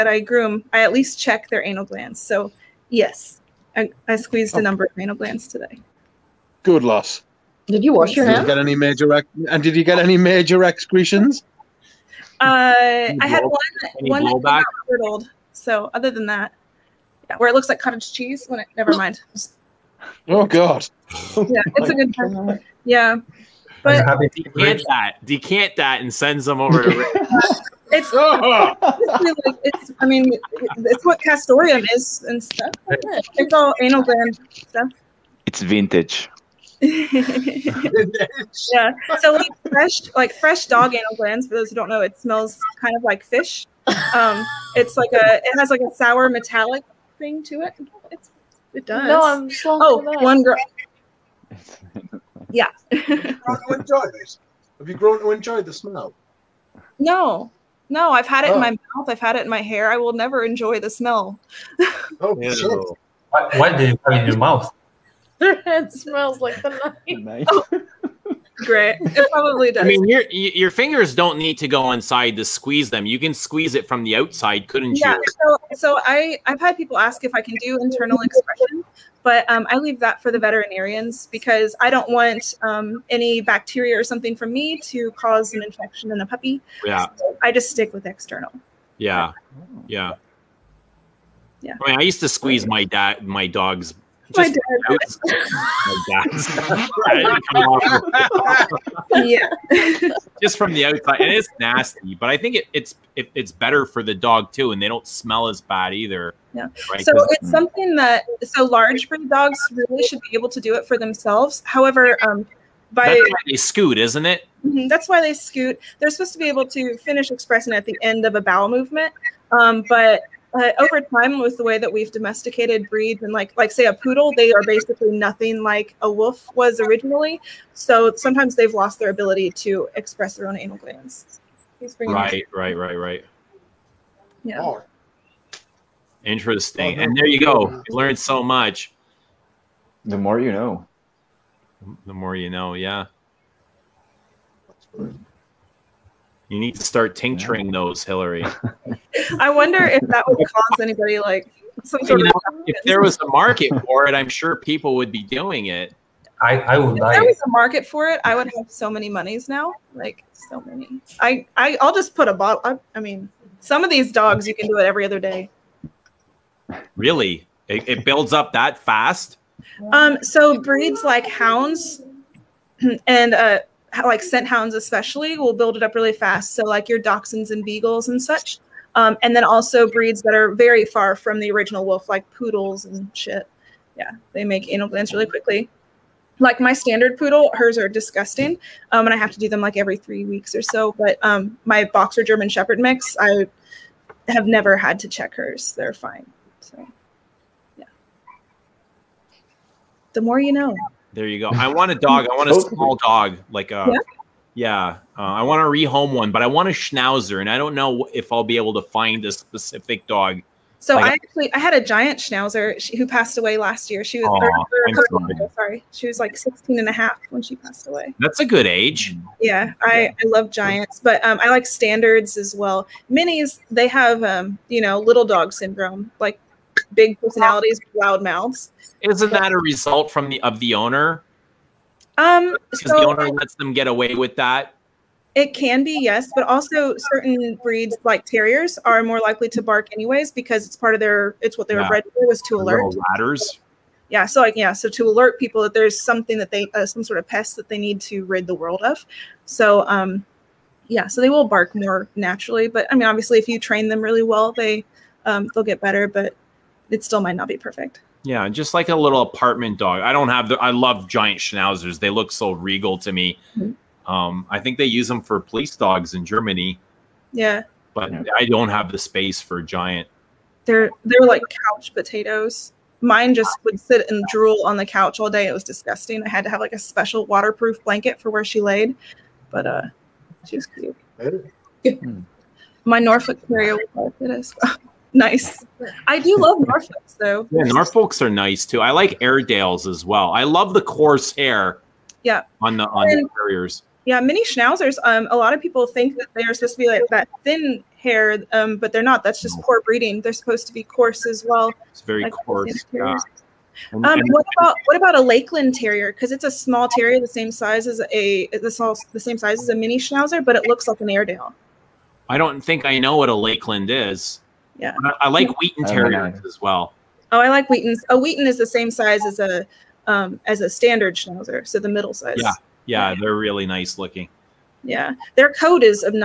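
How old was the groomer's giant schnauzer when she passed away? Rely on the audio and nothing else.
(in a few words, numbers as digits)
16 and a half.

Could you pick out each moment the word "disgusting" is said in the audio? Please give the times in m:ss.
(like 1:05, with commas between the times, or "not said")
3:07, 4:35.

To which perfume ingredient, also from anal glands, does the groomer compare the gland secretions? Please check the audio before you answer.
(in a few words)
Castoreum.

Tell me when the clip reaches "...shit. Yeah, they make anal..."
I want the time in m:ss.
3:03.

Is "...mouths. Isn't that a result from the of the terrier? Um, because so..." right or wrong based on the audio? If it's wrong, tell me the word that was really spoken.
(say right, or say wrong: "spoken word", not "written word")
wrong: "owner", not "terrier".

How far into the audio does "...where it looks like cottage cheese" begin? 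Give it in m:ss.
0:17.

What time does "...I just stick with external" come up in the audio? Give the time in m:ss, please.
1:27.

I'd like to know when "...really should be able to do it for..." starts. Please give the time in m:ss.
1:49.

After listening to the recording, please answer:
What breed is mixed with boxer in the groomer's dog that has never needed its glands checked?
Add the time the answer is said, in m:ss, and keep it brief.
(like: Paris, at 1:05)
German Shepherd, at 3:12.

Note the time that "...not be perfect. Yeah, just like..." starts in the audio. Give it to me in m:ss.
4:17.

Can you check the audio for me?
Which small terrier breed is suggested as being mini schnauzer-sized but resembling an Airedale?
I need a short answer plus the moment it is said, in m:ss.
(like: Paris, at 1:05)
Lakeland Terrier, at 5:05.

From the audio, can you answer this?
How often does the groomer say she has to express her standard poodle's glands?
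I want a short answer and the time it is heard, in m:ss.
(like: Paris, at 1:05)
Every 3 weeks, at 3:09.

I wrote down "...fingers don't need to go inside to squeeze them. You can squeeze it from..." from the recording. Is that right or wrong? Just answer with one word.
right.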